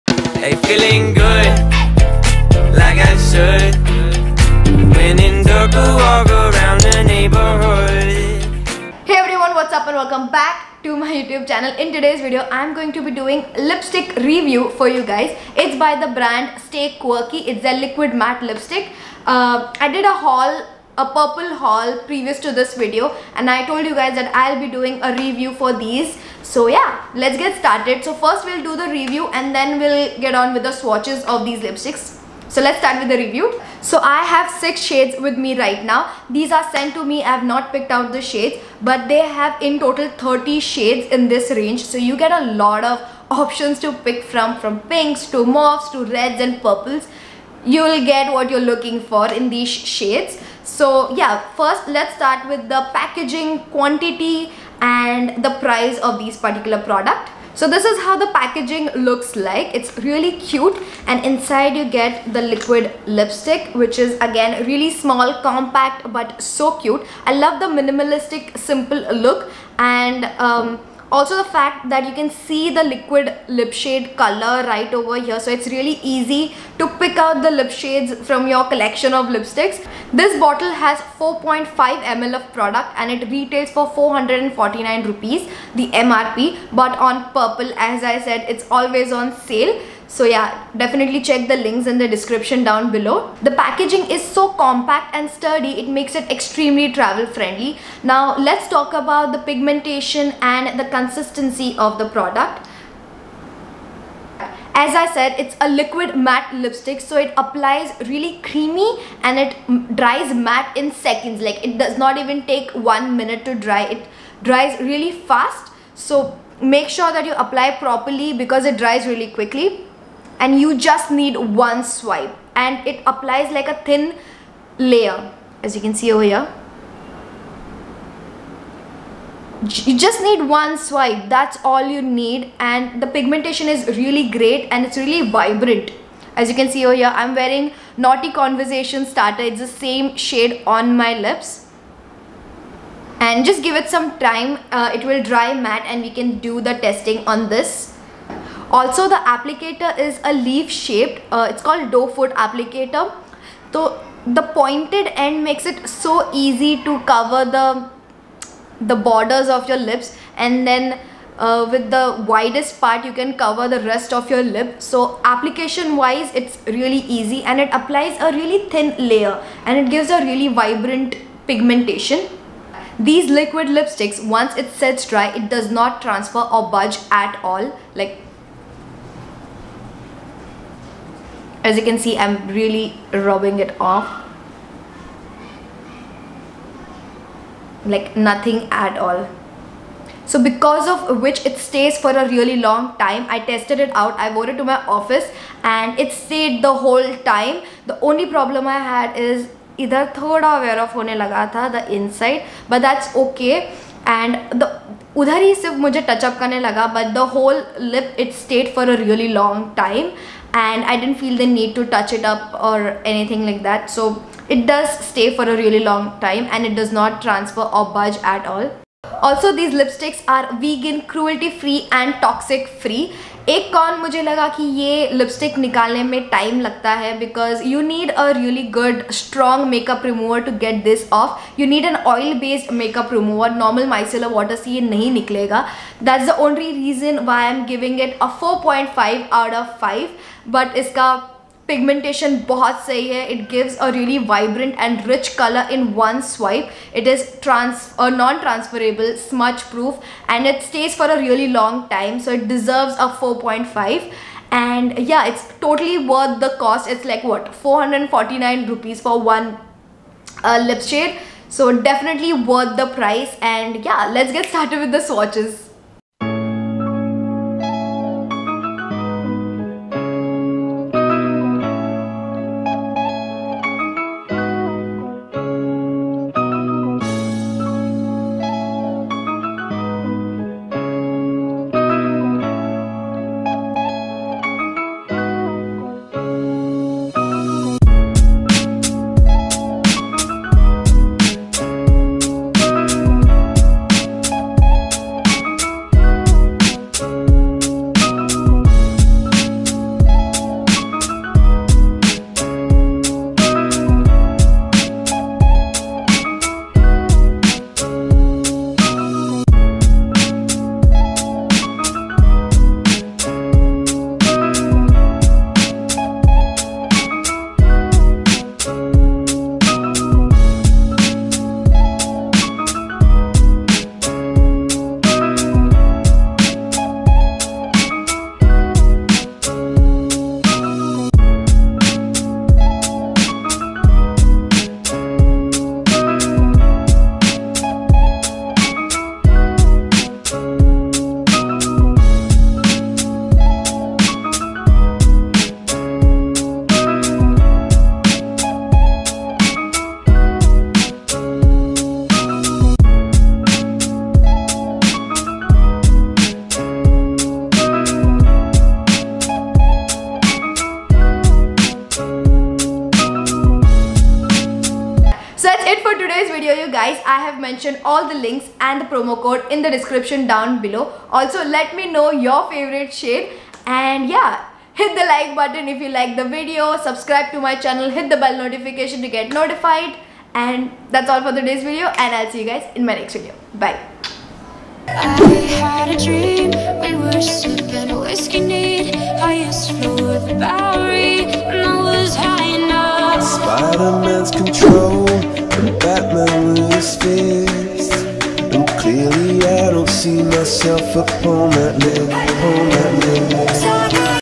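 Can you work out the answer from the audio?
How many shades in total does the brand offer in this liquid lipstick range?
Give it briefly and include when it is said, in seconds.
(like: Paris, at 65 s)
30, at 40 s.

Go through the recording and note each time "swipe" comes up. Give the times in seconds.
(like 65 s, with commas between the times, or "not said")
121 s, 130 s, 246 s.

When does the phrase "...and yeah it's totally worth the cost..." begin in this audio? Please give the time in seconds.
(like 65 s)
254 s.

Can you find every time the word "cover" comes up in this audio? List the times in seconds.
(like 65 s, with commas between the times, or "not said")
157 s, 163 s.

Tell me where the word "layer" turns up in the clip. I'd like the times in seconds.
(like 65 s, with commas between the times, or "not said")
124 s, 169 s.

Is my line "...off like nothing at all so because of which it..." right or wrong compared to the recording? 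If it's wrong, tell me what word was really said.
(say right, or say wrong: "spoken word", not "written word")
right.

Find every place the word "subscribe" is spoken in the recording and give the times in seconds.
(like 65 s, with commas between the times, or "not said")
376 s.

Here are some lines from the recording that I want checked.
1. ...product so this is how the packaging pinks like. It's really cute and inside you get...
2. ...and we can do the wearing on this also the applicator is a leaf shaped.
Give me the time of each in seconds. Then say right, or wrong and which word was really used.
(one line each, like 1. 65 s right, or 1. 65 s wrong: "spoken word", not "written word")
1. 56 s wrong: "looks", not "pinks"
2. 145 s wrong: "testing", not "wearing".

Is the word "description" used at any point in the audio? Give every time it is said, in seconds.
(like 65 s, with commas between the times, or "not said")
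92 s, 369 s.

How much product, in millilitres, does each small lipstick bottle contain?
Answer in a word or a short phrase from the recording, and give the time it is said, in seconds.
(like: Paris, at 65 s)
4.5 ml, at 81 s.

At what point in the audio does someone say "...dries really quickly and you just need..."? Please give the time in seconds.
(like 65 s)
118 s.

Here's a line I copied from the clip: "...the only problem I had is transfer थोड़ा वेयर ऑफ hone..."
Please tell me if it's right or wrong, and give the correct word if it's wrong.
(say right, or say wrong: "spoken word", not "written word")
wrong: "either", not "transfer".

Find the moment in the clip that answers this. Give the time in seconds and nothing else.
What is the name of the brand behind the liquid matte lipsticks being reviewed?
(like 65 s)
16 s.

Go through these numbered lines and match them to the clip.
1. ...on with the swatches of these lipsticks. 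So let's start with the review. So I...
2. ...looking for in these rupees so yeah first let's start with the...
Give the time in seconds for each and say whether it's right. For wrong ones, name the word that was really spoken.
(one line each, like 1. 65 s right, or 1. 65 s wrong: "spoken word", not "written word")
1. 30 s right
2. 48 s wrong: "shades", not "rupees".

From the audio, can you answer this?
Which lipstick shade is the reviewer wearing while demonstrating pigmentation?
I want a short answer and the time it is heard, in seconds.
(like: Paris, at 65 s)
Naughty Conversation Starter, at 137 s.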